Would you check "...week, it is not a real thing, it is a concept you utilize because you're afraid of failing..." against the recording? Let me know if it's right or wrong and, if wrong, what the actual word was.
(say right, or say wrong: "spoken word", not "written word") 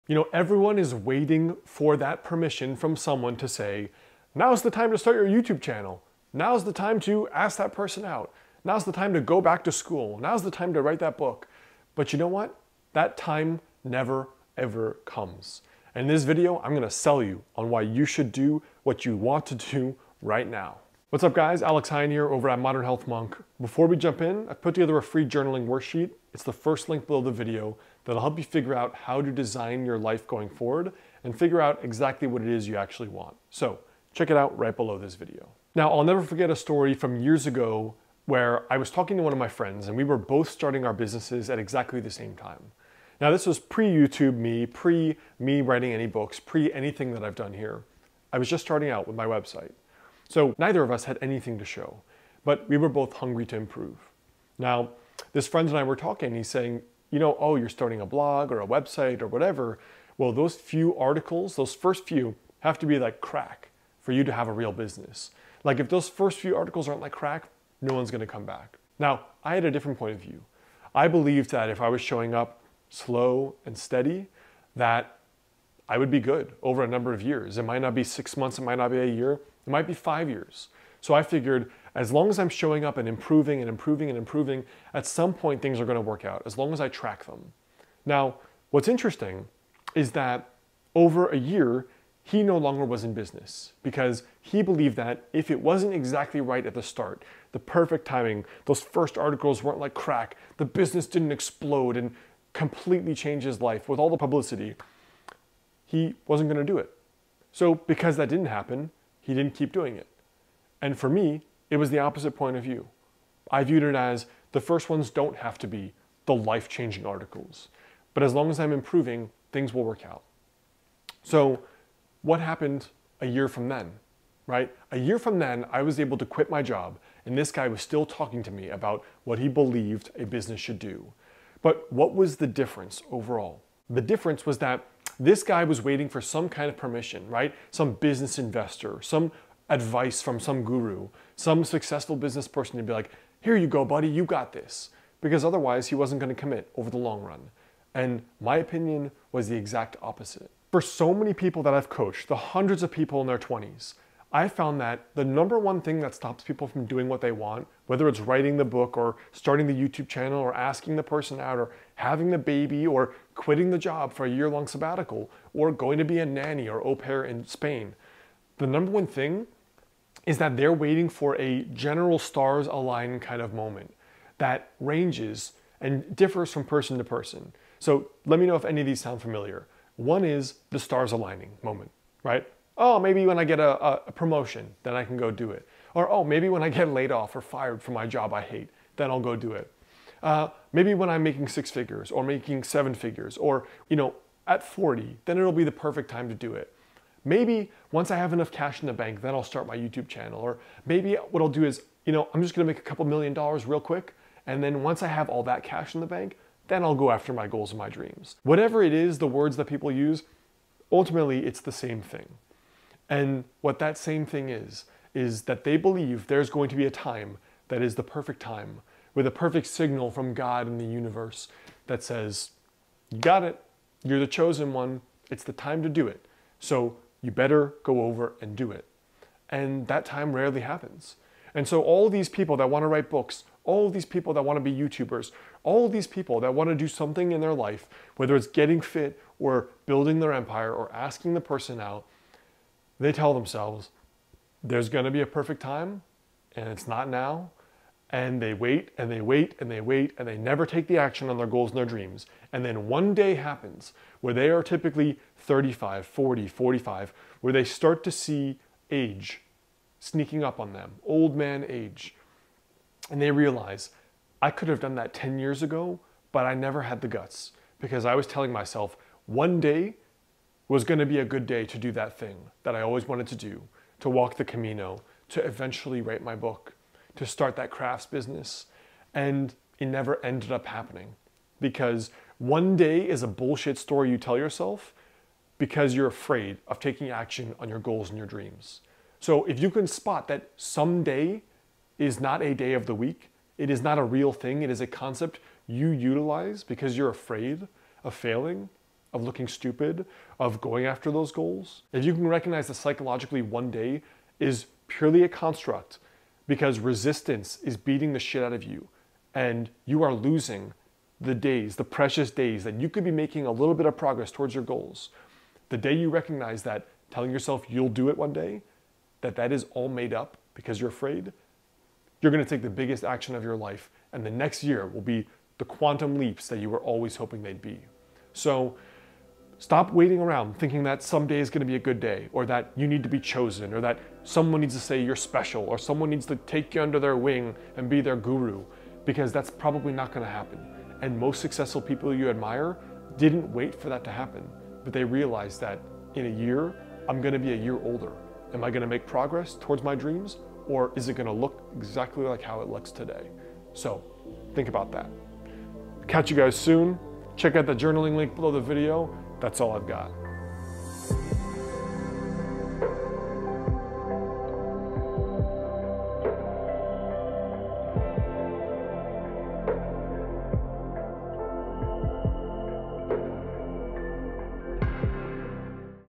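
right.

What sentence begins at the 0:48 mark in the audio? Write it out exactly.
I was just starting out with my website.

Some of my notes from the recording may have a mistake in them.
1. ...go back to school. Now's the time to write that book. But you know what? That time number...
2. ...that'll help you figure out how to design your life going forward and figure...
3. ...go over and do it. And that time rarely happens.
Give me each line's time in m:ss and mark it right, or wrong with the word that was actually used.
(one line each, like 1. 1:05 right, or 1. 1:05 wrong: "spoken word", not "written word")
1. 0:09 wrong: "never", not "number"
2. 0:28 right
3. 3:47 right.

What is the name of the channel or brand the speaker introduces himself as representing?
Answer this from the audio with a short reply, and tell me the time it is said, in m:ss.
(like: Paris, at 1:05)
Modern Health Monk, at 0:22.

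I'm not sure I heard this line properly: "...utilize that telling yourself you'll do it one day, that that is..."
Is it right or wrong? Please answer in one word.
wrong.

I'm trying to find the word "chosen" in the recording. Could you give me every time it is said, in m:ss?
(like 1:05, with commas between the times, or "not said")
3:44, 5:33.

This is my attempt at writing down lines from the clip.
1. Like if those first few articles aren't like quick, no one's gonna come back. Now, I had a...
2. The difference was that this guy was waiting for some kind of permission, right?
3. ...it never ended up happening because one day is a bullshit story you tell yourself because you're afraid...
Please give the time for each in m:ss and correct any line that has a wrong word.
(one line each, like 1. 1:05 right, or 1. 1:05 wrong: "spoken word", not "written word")
1. 1:05 wrong: "crack", not "quick"
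2. 2:13 right
3. 4:39 right.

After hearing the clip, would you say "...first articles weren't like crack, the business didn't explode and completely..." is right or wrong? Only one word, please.
right.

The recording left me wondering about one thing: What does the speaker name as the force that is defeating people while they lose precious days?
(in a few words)
resistance.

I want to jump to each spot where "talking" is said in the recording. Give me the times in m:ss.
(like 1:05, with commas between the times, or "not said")
0:38, 0:55, 2:08.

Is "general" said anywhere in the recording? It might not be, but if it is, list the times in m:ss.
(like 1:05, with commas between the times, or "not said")
2:51.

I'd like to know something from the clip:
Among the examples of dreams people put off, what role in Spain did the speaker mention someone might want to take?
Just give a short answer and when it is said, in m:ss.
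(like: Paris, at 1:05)
nanny or au pair, at 2:46.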